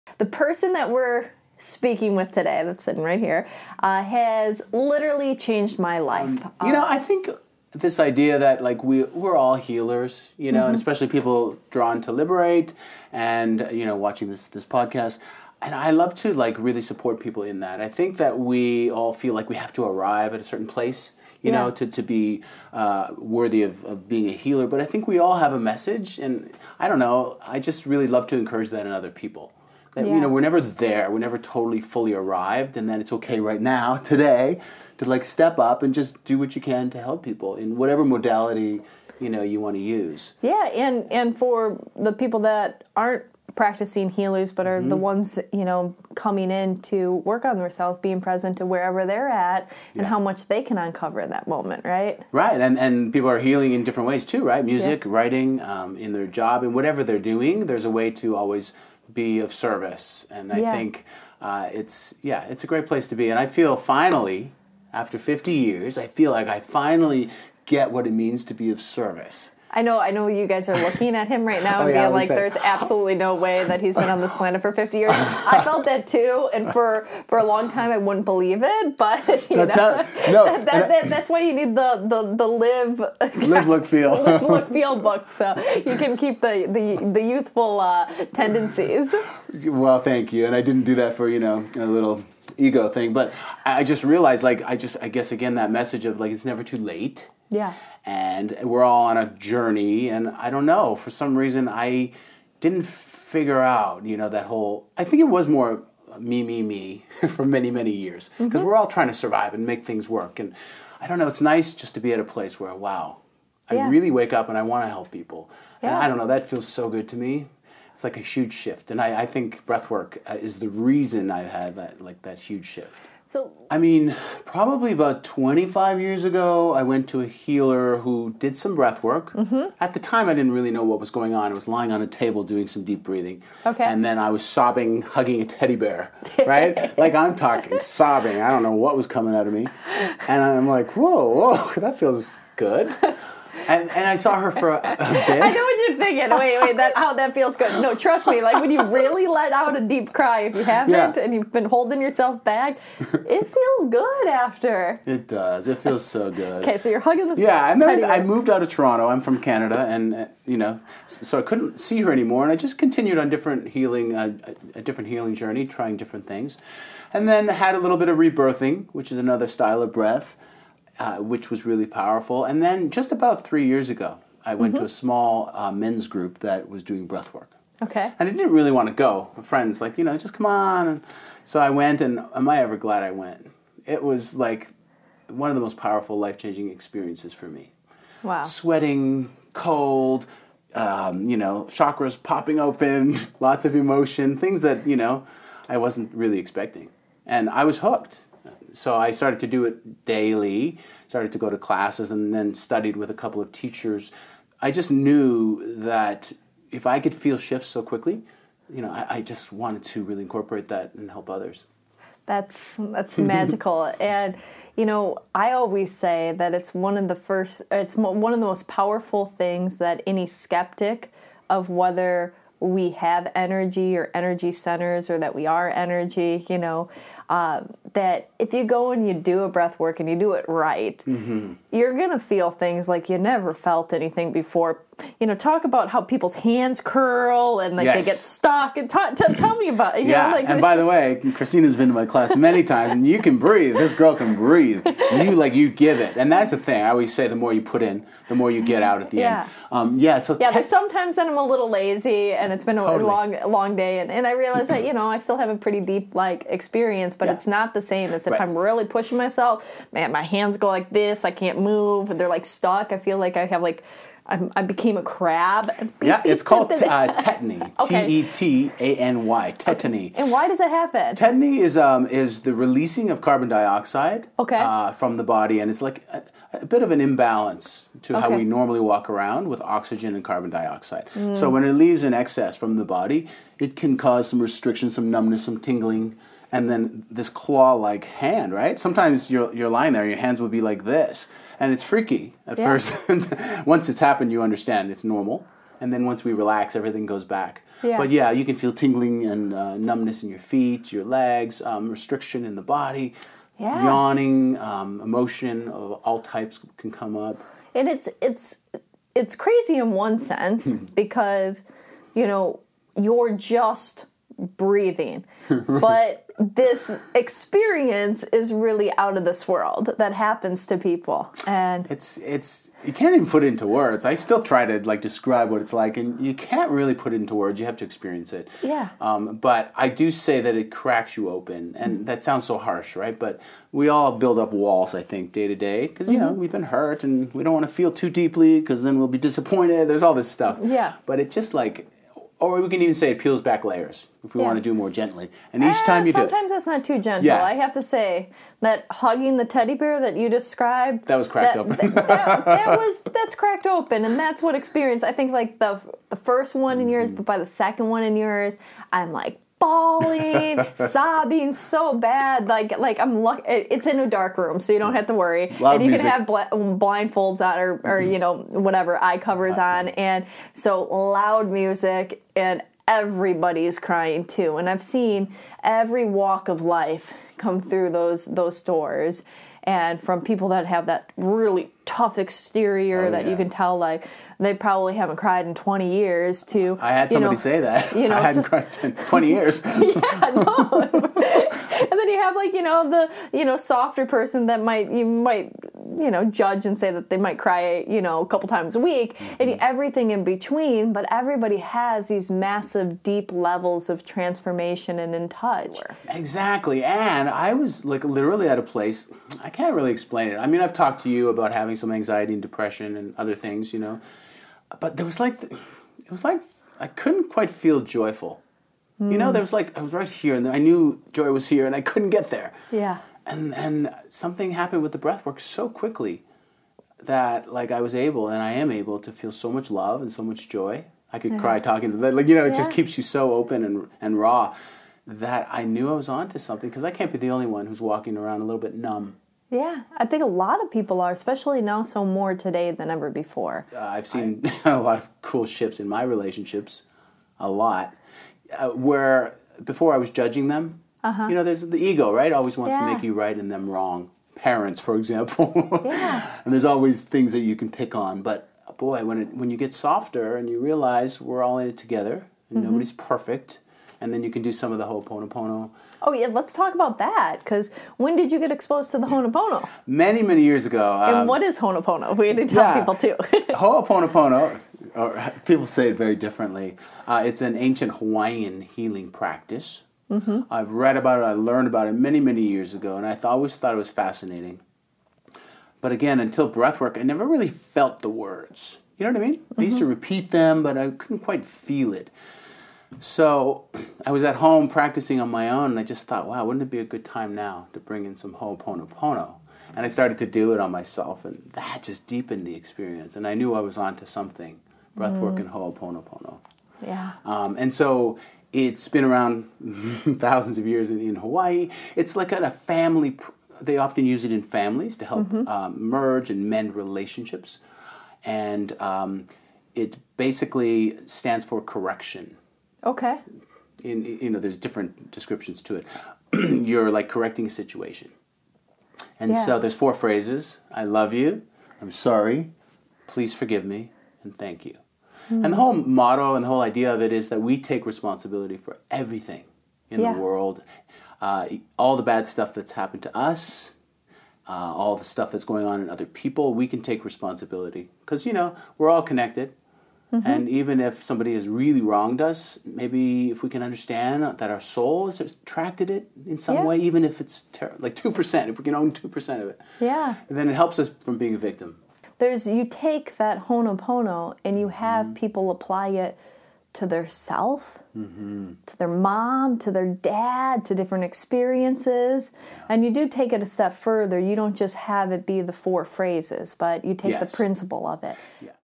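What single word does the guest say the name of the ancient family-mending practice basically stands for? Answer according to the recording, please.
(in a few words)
Correction.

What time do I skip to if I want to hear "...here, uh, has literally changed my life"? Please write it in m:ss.
0:03.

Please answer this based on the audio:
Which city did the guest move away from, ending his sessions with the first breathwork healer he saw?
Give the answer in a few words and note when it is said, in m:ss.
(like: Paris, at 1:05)
Toronto, at 2:38.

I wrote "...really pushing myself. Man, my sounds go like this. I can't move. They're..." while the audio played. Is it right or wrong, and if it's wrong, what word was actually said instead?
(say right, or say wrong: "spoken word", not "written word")
wrong: "hands", not "sounds".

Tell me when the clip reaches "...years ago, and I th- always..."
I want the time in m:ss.
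8:02.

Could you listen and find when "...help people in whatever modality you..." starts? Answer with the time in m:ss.
0:37.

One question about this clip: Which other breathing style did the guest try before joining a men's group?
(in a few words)
Rebirthing.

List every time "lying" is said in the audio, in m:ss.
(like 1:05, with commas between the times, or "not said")
2:11, 4:49.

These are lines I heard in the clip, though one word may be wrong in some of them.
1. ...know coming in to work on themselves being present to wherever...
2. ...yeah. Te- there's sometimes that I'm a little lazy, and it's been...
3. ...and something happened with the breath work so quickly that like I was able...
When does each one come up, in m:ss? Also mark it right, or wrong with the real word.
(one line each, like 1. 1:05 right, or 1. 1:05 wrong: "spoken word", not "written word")
1. 0:45 right
2. 4:10 right
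3. 7:03 right.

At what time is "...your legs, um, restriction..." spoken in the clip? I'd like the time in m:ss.
5:00.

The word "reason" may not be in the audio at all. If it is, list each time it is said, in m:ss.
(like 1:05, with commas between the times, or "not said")
1:41, 2:00.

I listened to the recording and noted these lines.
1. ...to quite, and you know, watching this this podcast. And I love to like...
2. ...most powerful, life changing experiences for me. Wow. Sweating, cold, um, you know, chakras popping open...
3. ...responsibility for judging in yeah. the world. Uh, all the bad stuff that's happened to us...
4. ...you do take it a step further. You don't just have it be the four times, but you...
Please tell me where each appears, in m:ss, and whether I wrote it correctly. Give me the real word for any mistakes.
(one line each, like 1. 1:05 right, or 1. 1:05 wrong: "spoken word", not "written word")
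1. 0:12 wrong: "liberate", not "quite"
2. 3:05 right
3. 8:57 wrong: "everything", not "judging"
4. 9:32 wrong: "phrases", not "times".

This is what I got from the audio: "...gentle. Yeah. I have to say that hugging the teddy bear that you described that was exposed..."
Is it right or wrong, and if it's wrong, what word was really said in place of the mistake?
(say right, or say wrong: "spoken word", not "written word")
wrong: "cracked", not "exposed".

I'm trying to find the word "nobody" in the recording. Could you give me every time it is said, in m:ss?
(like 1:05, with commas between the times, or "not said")
7:42.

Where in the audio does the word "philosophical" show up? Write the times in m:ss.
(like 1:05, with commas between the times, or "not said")
not said.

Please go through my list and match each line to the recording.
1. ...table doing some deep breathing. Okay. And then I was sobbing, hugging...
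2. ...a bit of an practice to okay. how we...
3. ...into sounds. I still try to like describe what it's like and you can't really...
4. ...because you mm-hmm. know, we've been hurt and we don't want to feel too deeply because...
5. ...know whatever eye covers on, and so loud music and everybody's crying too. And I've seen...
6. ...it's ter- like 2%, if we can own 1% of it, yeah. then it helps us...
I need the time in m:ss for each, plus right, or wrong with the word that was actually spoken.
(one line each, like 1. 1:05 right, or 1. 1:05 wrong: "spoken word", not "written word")
1. 2:12 right
2. 4:36 wrong: "imbalance", not "practice"
3. 5:23 wrong: "words", not "sounds"
4. 5:35 right
5. 6:08 right
6. 9:17 wrong: "2", not "1".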